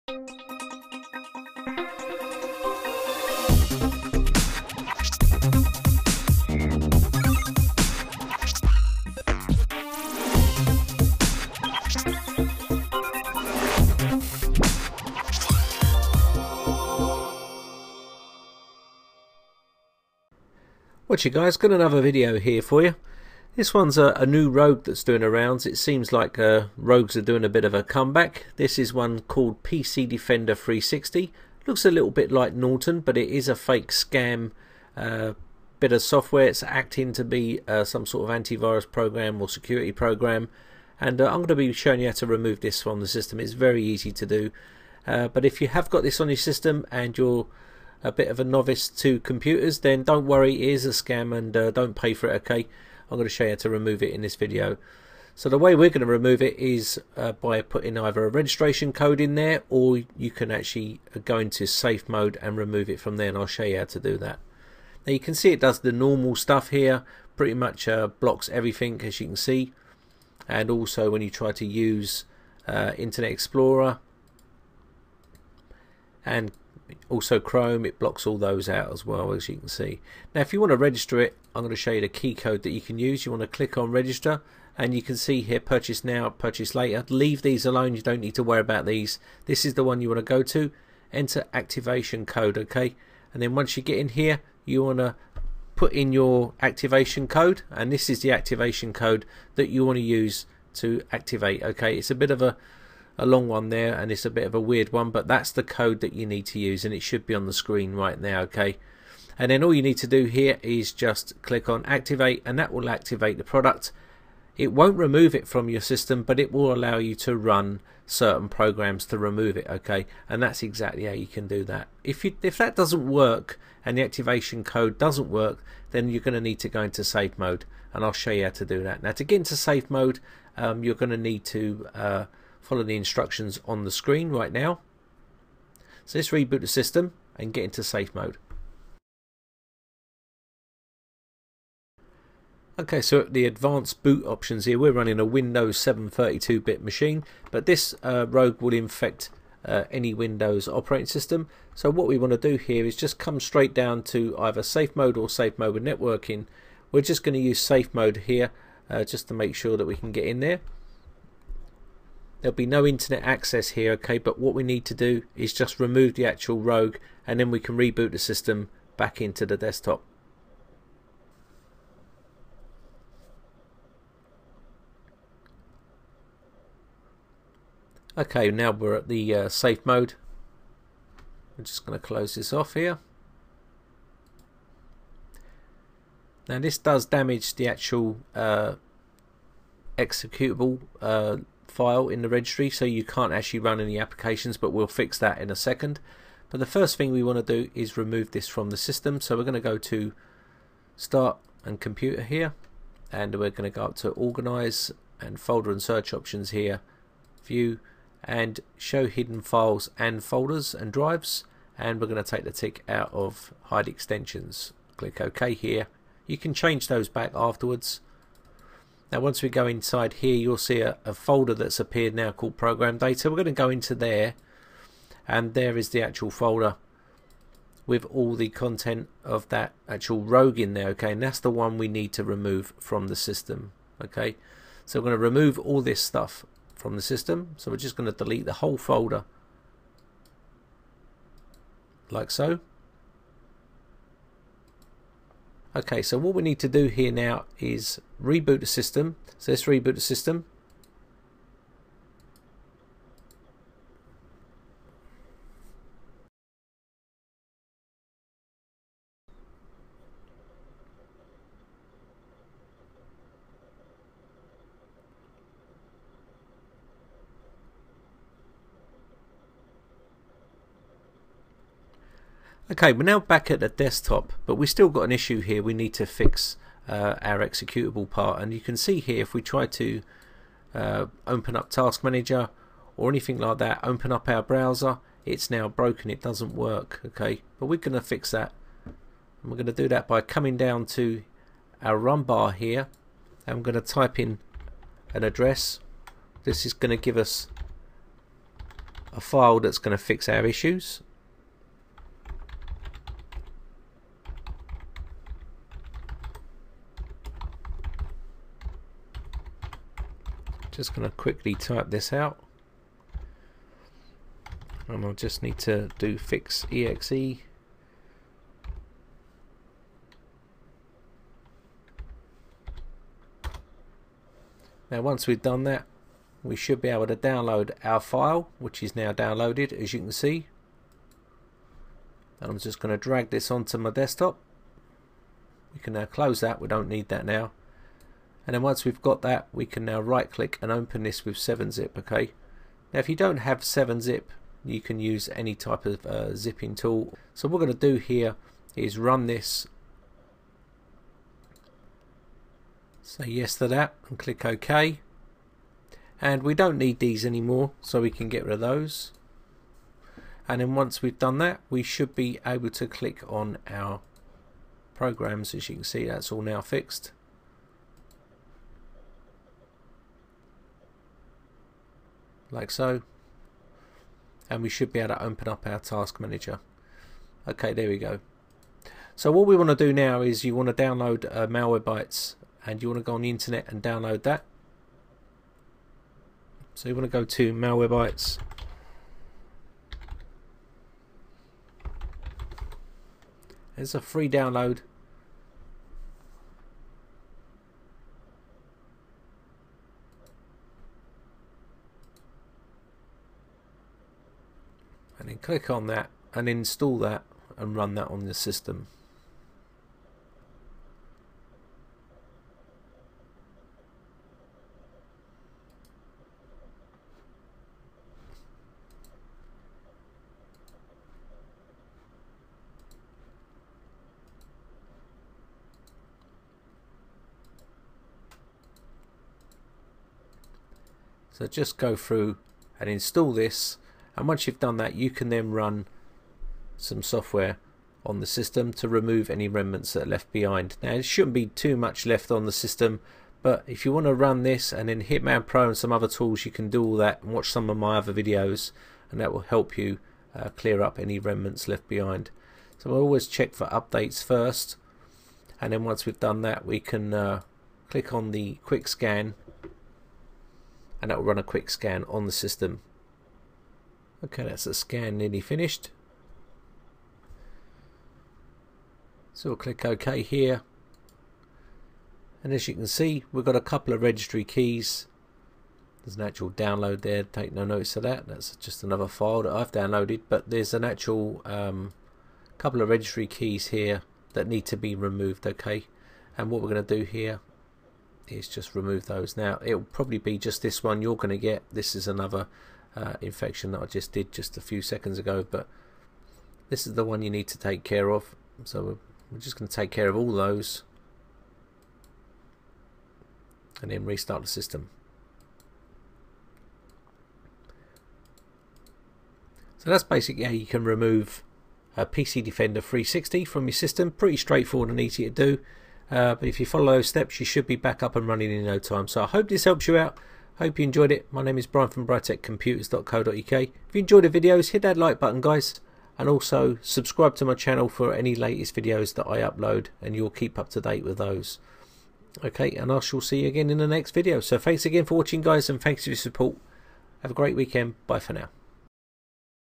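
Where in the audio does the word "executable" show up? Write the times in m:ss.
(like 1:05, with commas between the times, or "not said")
3:09, 4:37.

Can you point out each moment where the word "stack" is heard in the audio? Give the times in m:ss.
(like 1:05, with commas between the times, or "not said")
not said.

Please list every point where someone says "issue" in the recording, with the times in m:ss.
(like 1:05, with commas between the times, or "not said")
4:35, 5:00.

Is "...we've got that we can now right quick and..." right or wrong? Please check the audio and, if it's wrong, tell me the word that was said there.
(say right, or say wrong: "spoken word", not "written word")
wrong: "click", not "quick".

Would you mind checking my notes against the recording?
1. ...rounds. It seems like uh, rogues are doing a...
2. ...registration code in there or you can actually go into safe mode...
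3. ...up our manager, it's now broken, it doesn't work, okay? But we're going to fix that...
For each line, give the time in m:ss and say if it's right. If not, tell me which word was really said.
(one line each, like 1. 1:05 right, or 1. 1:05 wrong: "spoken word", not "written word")
1. 0:25 right
2. 0:58 right
3. 4:44 wrong: "browser", not "manager".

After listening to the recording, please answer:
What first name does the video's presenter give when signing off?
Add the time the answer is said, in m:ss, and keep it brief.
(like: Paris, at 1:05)
Brian, at 8:41.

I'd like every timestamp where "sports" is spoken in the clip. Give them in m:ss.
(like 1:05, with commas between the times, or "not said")
not said.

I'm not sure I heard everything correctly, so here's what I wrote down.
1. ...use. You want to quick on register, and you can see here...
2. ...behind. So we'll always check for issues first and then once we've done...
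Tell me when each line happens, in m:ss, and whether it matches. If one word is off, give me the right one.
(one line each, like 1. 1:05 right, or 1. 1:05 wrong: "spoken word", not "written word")
1. 1:22 wrong: "click", not "quick"
2. 7:31 wrong: "updates", not "issues".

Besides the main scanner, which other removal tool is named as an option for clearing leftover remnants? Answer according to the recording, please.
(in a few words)
Hitman Pro.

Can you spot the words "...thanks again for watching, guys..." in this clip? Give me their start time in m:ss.
8:54.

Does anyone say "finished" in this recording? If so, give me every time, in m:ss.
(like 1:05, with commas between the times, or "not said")
7:45.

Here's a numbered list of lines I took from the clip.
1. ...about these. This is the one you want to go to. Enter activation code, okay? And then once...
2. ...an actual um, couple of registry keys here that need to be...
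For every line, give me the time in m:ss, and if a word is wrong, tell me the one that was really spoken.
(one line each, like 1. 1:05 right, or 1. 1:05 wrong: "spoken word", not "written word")
1. 1:28 right
2. 8:00 right.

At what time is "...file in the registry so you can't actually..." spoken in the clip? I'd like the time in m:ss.
3:11.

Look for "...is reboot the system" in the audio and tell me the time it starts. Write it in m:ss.
4:07.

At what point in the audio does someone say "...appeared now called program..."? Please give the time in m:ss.
3:41.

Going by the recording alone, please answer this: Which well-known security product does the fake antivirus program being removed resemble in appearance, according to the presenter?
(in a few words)
Norton.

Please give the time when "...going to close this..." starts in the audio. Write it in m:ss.
3:01.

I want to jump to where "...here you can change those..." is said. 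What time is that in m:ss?
3:35.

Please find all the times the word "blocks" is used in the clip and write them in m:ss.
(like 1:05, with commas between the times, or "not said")
1:08, 1:17.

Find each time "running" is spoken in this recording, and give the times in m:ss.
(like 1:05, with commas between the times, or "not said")
2:24, 8:38.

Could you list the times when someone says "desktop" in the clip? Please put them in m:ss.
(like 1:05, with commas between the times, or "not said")
2:49, 4:33, 5:33.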